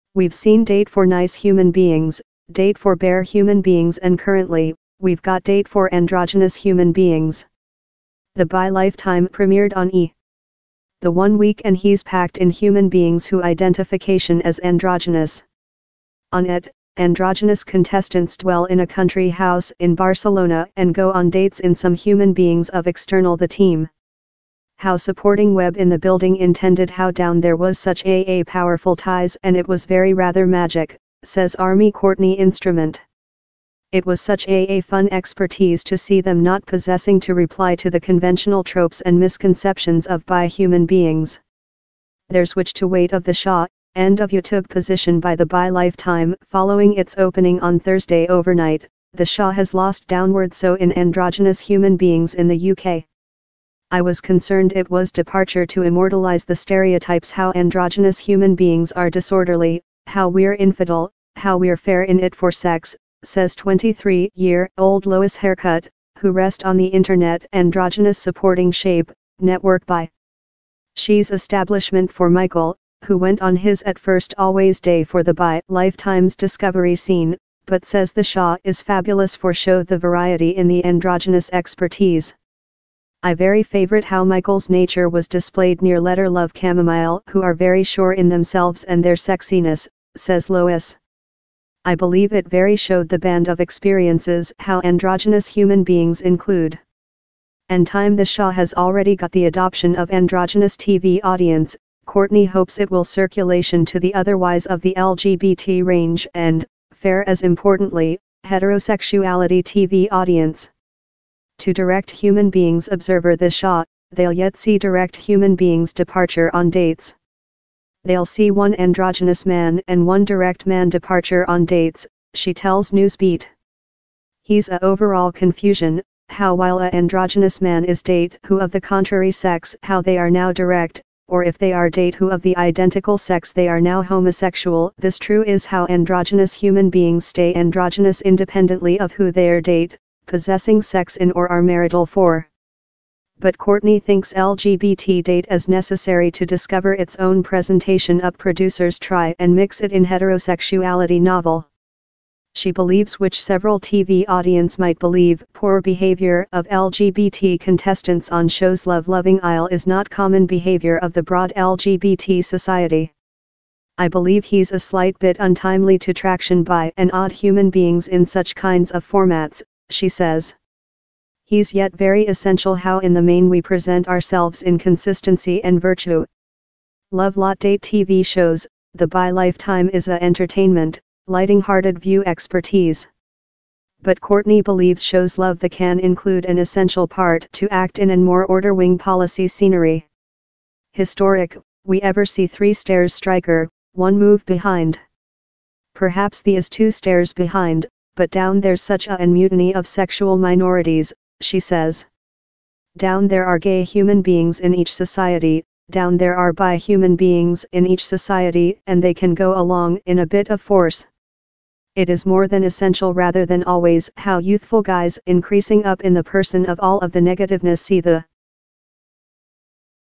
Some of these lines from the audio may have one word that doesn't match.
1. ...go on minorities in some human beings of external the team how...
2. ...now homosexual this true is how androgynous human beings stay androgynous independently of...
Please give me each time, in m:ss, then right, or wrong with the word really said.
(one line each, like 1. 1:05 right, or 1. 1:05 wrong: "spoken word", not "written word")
1. 0:20 wrong: "dates", not "minorities"
2. 2:13 right.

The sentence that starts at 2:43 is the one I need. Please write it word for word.
I believe he's a slight bit untimely to traction by and odd human beings in such kinds of formats, she says.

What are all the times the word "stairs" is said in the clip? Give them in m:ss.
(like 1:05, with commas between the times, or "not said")
3:12, 3:16.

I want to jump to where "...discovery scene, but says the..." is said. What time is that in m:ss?
1:16.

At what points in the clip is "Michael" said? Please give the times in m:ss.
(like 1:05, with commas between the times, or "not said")
1:12, 1:24.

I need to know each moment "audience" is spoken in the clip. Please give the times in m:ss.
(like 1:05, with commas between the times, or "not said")
1:41, 1:50, 2:34.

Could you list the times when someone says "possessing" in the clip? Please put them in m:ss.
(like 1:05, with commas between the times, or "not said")
0:36, 2:20.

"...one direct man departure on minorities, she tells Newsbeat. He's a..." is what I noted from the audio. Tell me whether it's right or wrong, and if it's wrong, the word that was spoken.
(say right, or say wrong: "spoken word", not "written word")
wrong: "dates", not "minorities".